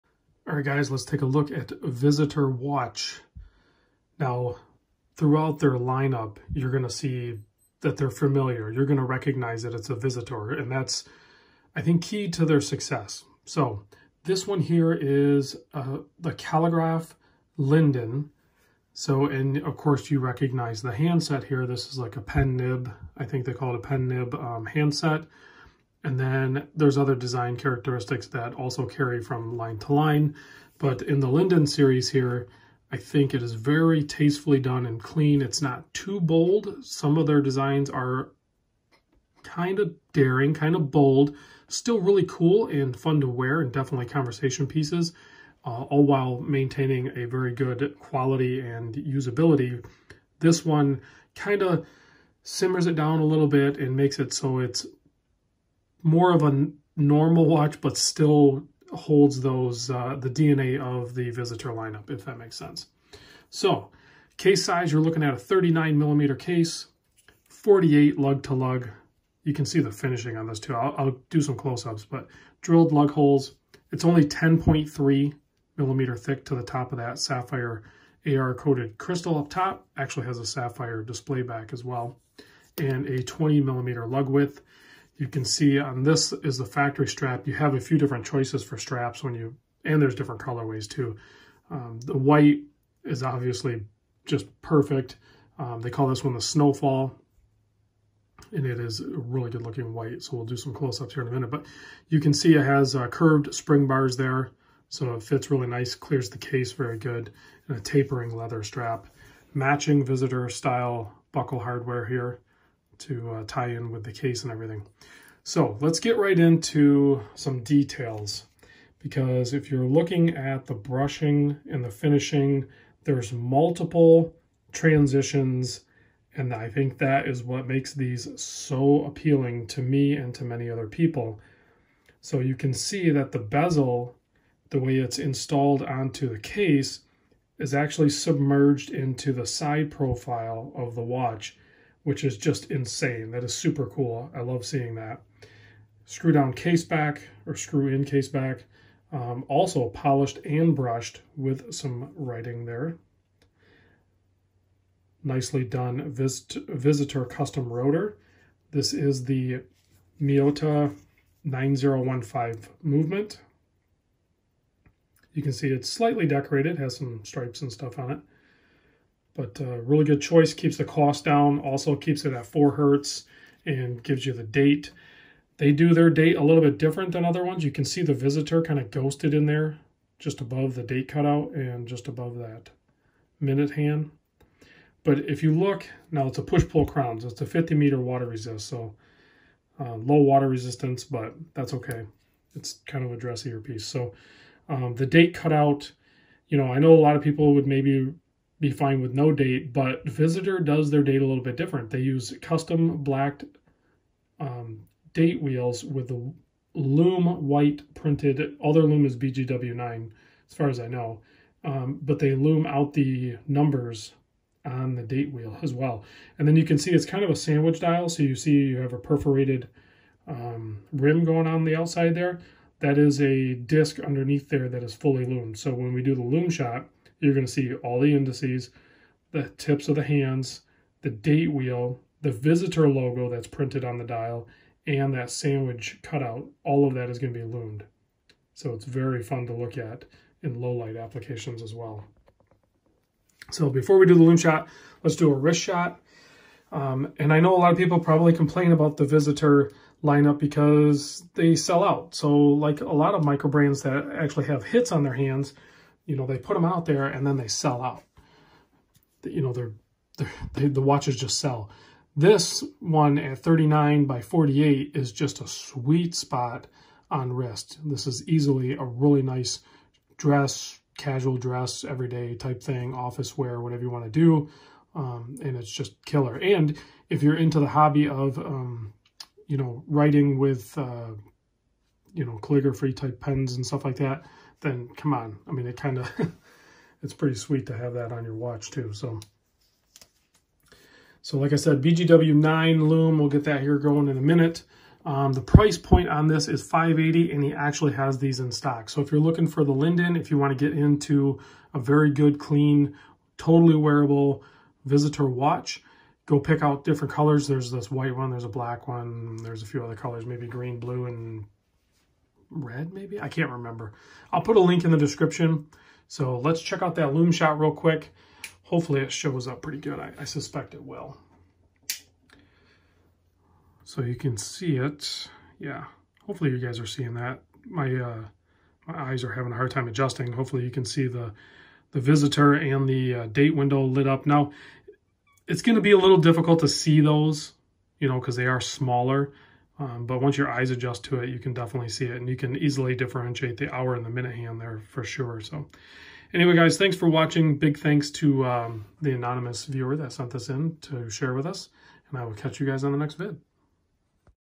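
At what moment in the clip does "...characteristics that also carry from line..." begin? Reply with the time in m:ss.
0:27.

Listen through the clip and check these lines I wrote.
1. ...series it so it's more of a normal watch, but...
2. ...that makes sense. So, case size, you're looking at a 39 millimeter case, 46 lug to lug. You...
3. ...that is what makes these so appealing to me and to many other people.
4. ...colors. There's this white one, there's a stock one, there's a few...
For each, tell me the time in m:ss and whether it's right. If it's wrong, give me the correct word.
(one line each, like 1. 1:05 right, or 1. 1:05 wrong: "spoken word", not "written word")
1. 0:53 wrong: "makes", not "series"
2. 1:02 wrong: "48", not "46"
3. 2:06 right
4. 5:07 wrong: "black", not "stock".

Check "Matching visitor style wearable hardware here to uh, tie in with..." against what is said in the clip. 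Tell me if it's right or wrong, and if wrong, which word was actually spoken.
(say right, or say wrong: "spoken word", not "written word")
wrong: "buckle", not "wearable".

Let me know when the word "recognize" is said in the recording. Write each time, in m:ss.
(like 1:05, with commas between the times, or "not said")
0:09, 0:20.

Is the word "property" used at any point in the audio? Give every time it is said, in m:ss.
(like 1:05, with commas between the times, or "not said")
not said.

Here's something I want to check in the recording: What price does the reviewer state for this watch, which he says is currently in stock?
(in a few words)
580.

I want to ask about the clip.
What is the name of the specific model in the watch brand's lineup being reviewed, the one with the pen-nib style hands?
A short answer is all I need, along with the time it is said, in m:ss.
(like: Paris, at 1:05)
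Calligraph Linden, at 0:16.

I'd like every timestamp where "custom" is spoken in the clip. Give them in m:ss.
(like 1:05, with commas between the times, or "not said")
2:37, 3:22.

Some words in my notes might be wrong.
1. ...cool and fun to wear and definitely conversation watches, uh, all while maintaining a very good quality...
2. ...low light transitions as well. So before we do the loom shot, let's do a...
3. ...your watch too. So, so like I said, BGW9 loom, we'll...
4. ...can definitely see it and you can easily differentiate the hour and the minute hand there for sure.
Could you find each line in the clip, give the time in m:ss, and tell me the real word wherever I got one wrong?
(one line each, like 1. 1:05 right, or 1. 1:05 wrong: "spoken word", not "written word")
1. 0:42 wrong: "pieces", not "watches"
2. 4:00 wrong: "applications", not "transitions"
3. 4:48 right
4. 5:41 right.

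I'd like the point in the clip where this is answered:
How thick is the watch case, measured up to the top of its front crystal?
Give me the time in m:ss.
1:14.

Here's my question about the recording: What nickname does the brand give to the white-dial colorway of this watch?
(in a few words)
snowfall.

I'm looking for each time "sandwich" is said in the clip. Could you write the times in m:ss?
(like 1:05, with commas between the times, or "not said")
3:37, 3:55.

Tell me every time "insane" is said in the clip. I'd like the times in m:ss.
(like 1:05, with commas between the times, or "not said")
2:22.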